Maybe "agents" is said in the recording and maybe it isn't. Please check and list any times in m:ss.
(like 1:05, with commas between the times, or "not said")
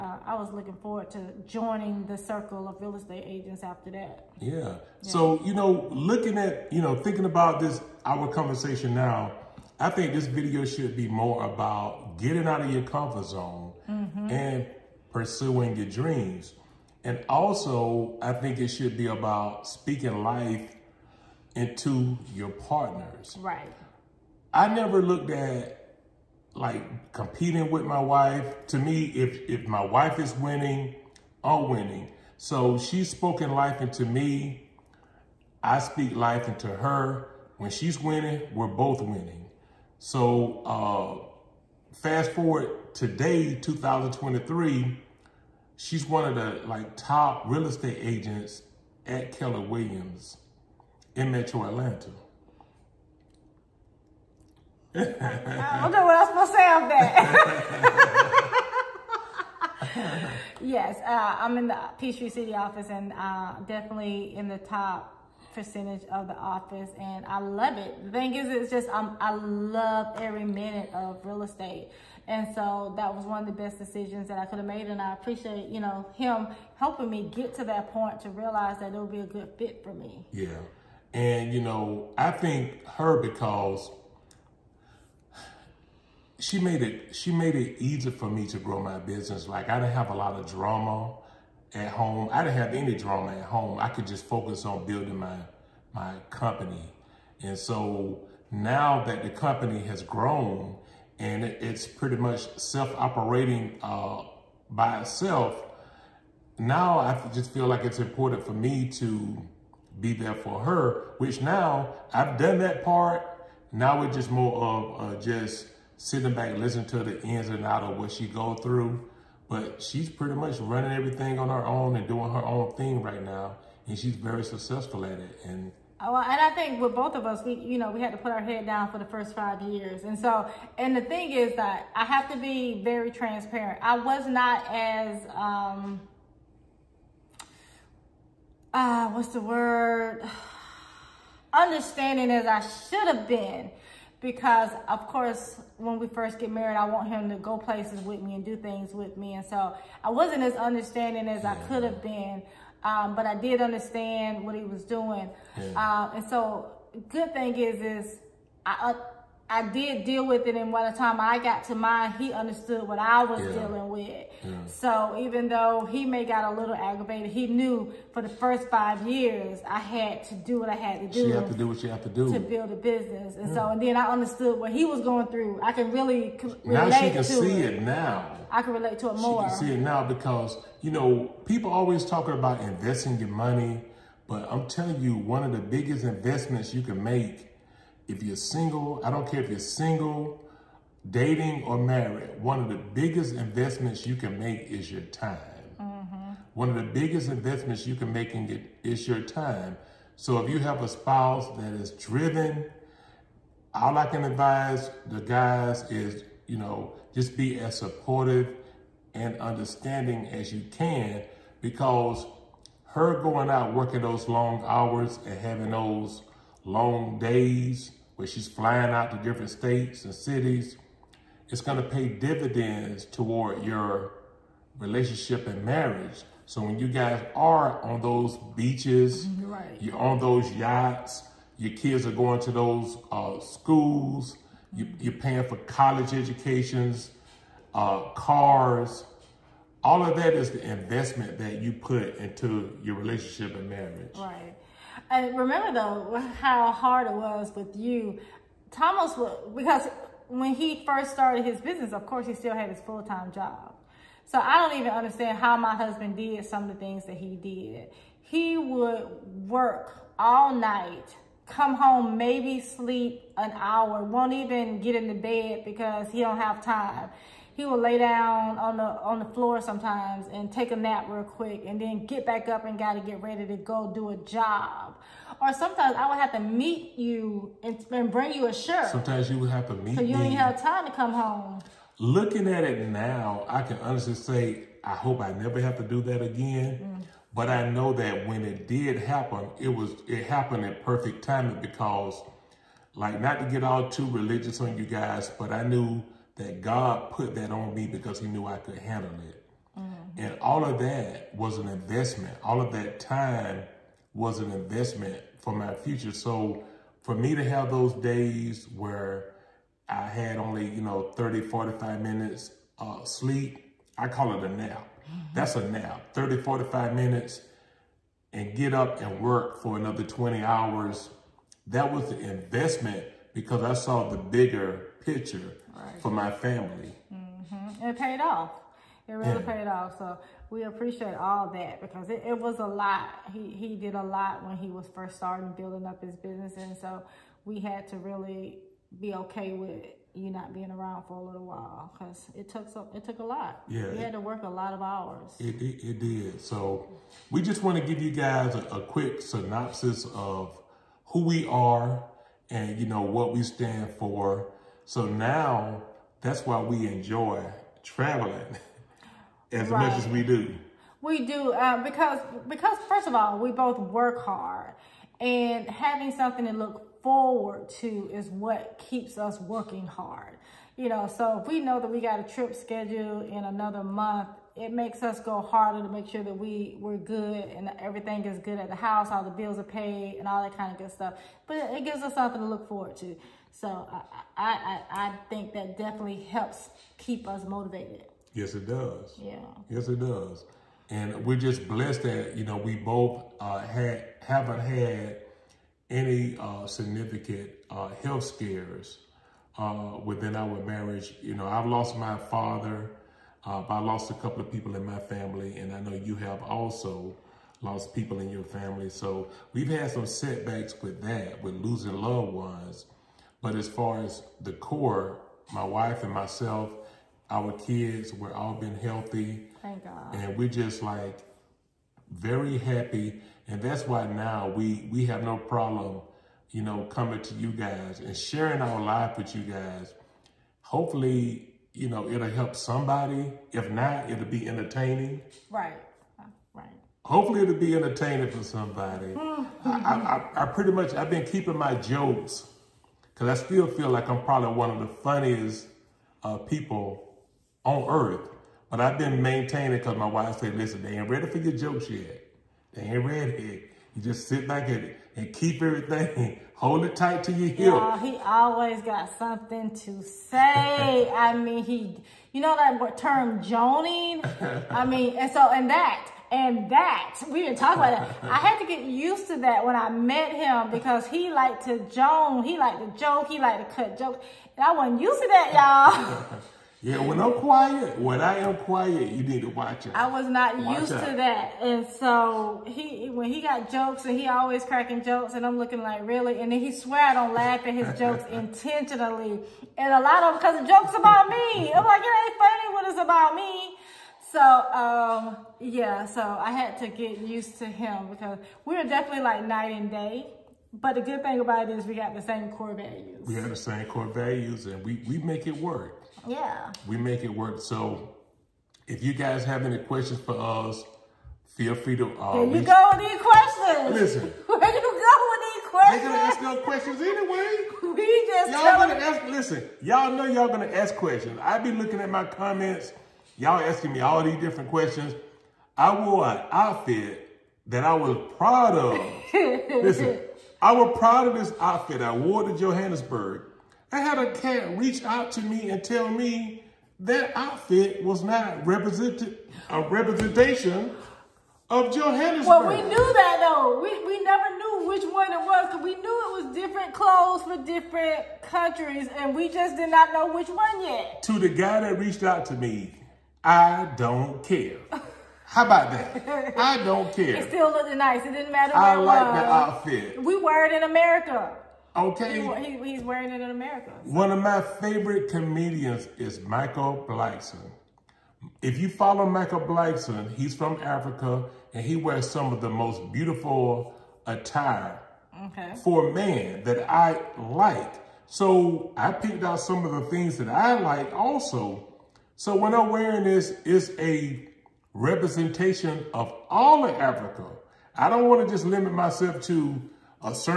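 0:03, 0:48.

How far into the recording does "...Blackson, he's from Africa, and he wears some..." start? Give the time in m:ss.
9:29.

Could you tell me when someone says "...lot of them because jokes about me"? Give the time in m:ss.
8:10.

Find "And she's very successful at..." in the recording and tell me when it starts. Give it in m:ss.
2:03.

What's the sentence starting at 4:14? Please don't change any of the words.
So I don't even understand how my husband did some of the things that he did.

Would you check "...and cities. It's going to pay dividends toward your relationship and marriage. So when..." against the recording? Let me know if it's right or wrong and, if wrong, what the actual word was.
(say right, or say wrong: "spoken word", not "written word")
right.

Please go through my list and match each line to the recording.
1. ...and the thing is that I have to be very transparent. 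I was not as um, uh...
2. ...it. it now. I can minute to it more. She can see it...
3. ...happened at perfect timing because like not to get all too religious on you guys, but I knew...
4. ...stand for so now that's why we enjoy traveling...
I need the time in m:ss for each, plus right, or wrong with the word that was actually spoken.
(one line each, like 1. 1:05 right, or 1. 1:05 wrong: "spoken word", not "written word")
1. 2:10 right
2. 2:57 wrong: "relate", not "minute"
3. 4:50 right
4. 5:53 right.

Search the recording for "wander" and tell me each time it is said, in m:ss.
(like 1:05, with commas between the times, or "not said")
not said.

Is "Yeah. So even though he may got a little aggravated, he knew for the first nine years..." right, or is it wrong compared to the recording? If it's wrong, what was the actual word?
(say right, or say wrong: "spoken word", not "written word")
wrong: "five", not "nine".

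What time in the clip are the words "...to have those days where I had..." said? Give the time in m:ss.
5:07.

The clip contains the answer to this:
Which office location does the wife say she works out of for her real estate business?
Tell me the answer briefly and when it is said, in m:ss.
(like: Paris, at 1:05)
Peachtree City, at 1:01.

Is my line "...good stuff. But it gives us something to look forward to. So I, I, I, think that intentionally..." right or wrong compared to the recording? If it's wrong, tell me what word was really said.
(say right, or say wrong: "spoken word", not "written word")
wrong: "definitely", not "intentionally".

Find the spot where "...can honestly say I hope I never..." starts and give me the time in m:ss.
4:43.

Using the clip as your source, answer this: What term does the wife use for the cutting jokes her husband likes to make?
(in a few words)
Joning.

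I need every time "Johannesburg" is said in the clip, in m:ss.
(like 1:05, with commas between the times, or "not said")
8:52, 9:01.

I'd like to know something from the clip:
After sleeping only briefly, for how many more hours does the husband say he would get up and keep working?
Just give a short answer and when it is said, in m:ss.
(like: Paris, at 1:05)
20, at 5:20.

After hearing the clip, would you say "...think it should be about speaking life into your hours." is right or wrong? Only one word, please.
wrong.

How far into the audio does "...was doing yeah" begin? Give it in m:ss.
2:34.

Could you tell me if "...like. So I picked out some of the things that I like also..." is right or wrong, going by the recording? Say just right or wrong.
right.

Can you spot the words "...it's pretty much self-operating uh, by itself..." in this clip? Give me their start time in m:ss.
1:41.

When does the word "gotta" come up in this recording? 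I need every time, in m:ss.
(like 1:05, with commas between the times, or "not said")
4:32.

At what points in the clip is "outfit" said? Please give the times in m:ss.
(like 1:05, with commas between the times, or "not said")
8:46, 8:51, 8:57, 9:19.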